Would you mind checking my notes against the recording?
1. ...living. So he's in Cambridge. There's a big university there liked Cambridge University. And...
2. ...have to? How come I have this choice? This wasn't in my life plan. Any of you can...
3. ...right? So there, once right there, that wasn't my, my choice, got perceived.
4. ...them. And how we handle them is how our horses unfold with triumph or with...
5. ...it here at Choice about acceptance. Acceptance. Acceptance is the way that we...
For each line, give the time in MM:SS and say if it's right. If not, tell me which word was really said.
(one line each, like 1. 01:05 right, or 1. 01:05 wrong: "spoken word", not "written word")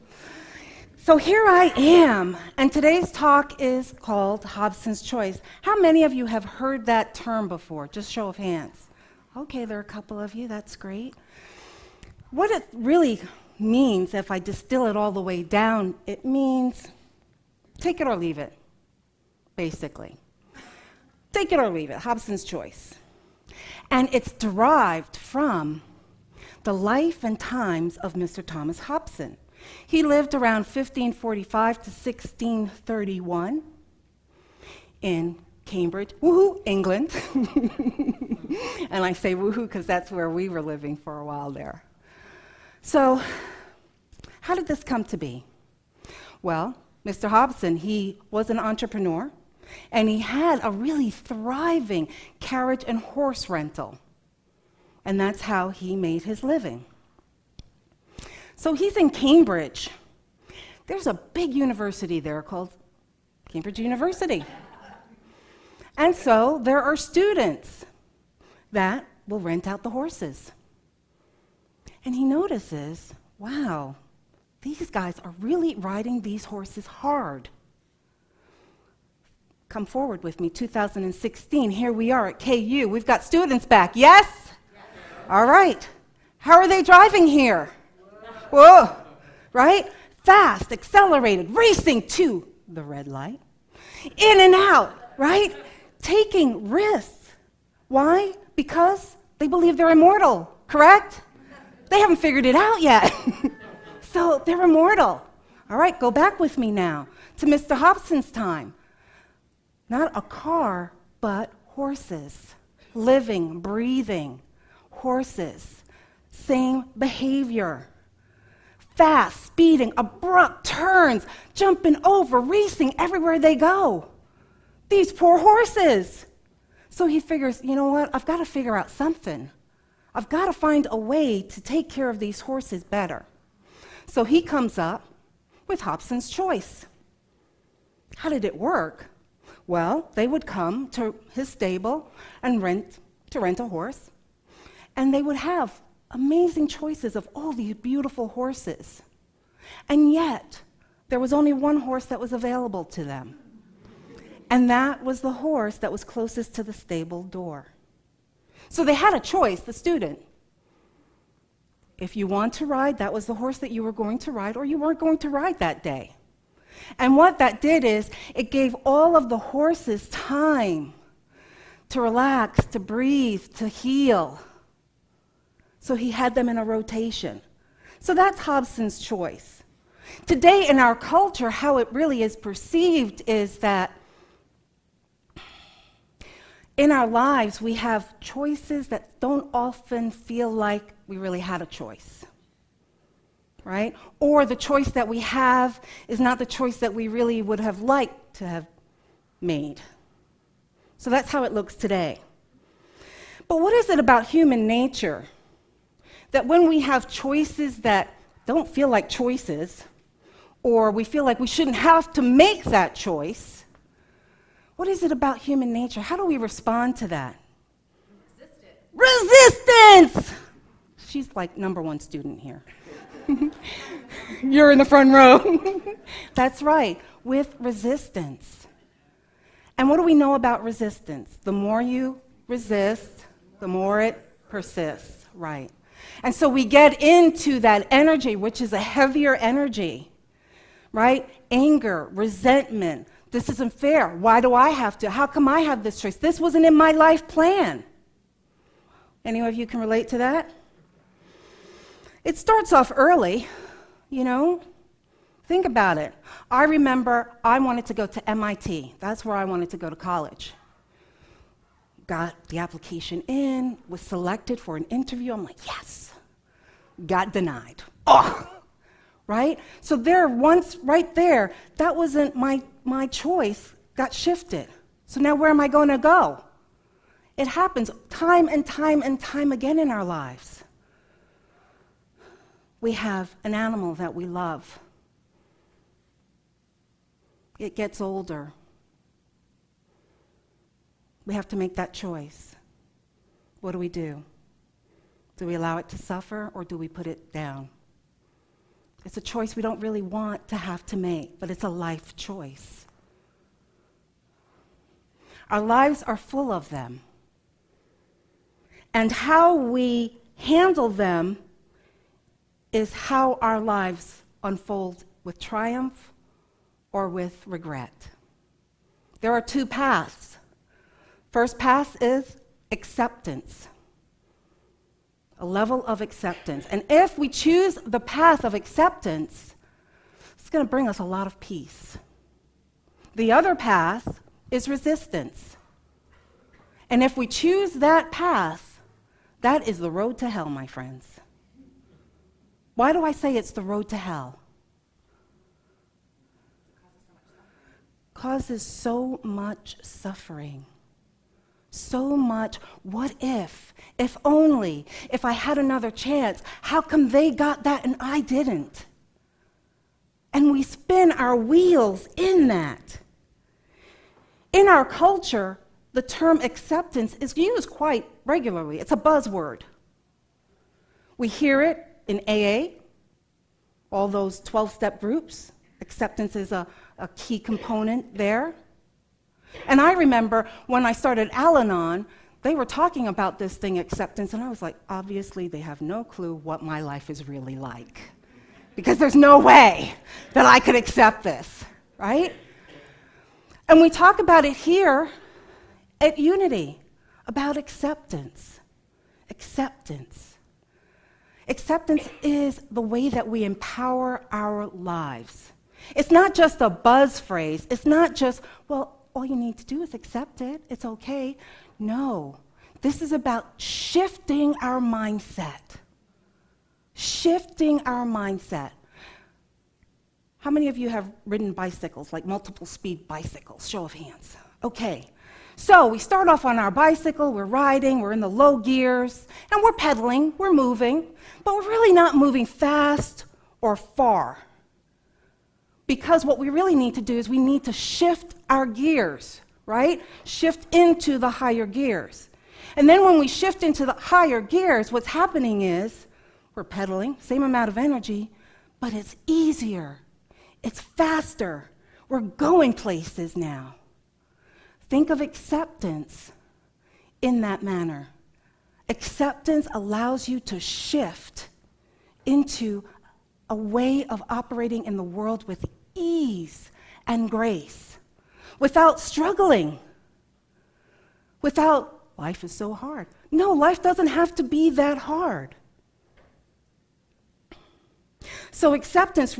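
1. 00:56 wrong: "called", not "liked"
2. 04:04 right
3. 04:29 wrong: "shifted", not "perceived"
4. 05:06 wrong: "lives", not "horses"
5. 06:34 wrong: "Unity", not "Choice".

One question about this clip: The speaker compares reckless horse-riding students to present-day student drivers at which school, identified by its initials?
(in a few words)
KU.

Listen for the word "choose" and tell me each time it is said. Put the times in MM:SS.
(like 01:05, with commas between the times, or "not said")
05:27, 05:37.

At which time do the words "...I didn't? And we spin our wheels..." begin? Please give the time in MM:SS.
05:58.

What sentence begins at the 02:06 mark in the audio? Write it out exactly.
So he figures, you know what?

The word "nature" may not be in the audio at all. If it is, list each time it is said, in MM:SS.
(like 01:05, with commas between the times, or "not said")
03:24, 03:35.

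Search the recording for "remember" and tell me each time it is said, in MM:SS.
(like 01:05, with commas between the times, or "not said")
04:16, 06:19.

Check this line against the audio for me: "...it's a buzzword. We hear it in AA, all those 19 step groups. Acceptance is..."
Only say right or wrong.
wrong.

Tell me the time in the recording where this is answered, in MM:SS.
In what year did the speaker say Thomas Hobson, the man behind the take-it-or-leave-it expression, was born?
00:30.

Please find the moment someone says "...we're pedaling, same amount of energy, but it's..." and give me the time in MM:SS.
07:26.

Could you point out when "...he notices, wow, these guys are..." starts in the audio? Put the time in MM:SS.
01:12.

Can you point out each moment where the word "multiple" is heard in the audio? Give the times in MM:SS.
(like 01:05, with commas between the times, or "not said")
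07:02.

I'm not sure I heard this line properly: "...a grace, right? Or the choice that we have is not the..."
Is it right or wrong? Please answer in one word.
wrong.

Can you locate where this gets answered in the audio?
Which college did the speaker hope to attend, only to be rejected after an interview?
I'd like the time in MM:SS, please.
04:18.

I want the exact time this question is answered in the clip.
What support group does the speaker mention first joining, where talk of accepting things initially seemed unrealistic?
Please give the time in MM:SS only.
06:21.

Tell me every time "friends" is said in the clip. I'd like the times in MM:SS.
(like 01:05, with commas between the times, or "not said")
05:40.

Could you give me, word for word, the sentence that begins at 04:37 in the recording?
It happens time and time and time again in our lives.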